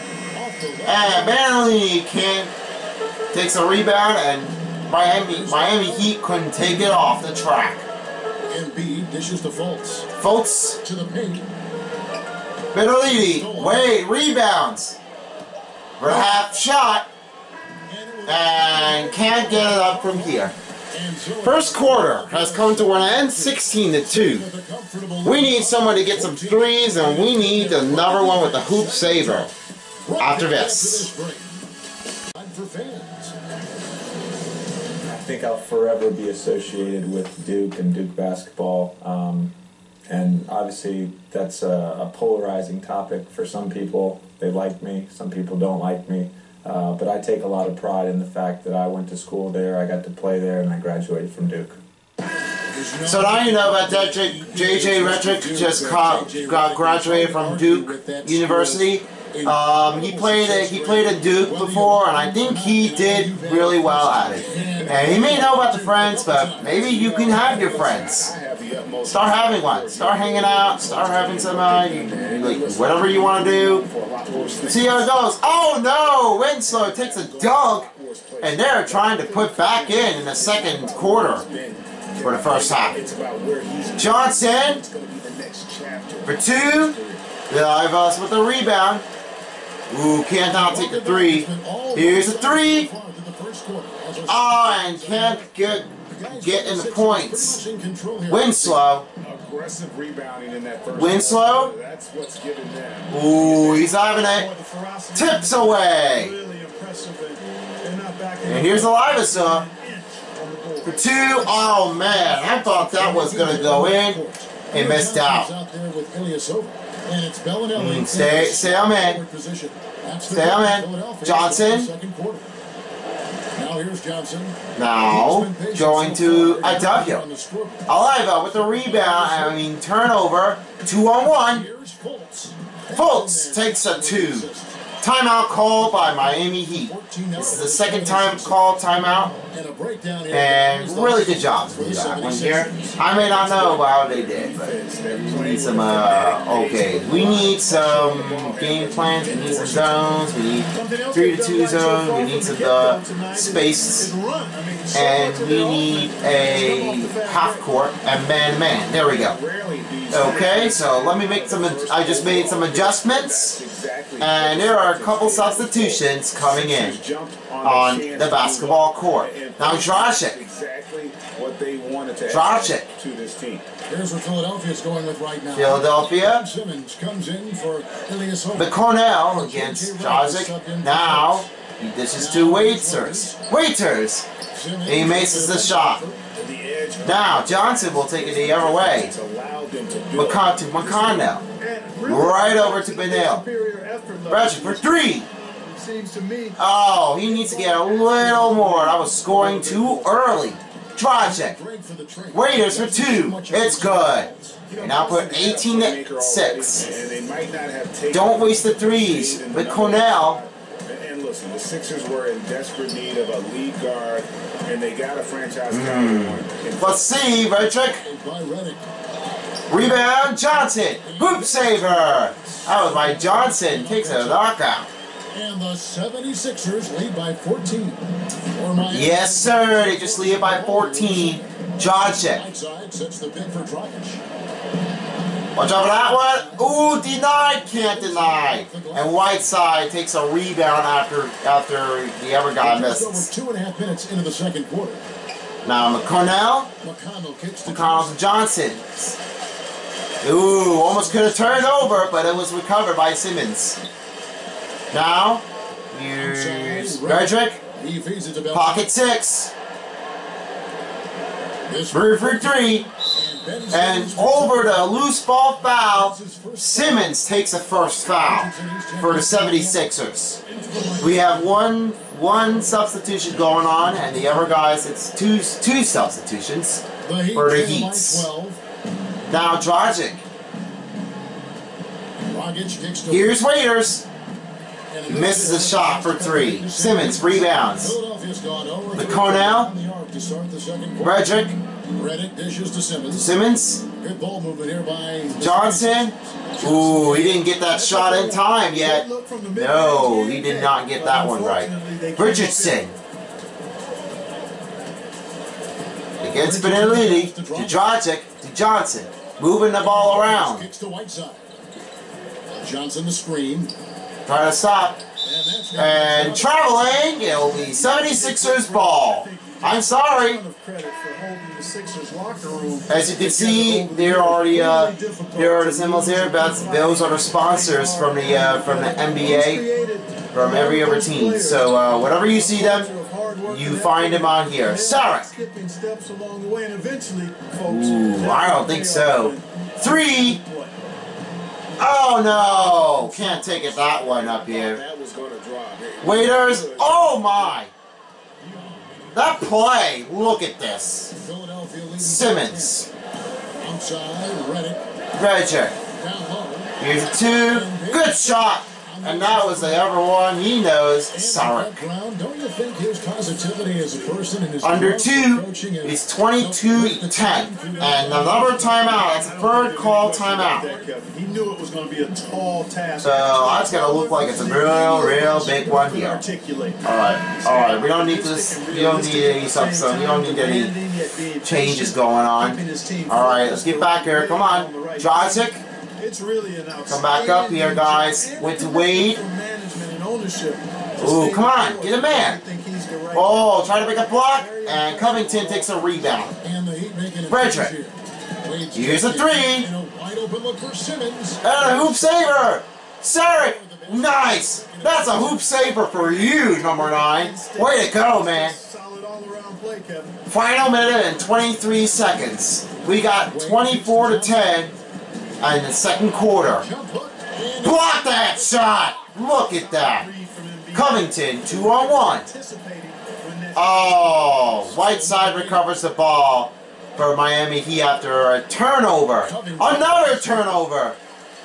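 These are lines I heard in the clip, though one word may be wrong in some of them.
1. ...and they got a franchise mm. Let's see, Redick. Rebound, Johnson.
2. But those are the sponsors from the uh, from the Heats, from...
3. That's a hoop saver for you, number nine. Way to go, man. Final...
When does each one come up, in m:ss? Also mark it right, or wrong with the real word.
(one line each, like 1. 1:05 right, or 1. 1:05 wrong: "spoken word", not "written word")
1. 3:34 right
2. 5:26 wrong: "NBA", not "Heats"
3. 6:44 right.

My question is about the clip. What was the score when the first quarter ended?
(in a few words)
16 to 2.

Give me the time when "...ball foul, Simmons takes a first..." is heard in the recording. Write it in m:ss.
4:25.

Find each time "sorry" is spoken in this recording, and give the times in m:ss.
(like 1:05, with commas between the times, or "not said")
5:19, 5:34.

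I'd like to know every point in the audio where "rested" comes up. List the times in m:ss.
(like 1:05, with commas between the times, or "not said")
not said.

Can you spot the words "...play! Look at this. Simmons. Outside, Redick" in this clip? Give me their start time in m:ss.
5:49.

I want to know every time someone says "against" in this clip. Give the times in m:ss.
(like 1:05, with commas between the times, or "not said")
2:59, 5:06.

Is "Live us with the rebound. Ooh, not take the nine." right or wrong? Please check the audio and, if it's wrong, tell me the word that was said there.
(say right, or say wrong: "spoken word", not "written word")
wrong: "three", not "nine".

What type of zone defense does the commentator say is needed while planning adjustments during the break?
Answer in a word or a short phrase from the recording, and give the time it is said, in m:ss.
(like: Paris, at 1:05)
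3 to 2 zone, at 2:30.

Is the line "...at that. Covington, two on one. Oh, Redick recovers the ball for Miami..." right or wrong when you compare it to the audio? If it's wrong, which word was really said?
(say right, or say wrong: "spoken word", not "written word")
wrong: "Whiteside", not "Redick".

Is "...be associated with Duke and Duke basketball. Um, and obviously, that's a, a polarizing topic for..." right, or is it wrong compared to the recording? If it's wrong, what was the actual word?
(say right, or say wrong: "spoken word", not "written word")
right.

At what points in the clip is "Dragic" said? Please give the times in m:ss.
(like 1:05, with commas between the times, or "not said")
2:49, 2:59, 4:39.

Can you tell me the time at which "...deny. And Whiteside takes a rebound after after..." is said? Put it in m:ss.
3:57.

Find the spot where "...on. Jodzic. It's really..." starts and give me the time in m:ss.
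6:24.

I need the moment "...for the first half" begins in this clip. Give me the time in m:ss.
1:22.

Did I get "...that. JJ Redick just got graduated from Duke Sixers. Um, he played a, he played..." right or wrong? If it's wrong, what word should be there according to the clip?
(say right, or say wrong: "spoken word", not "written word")
wrong: "University", not "Sixers".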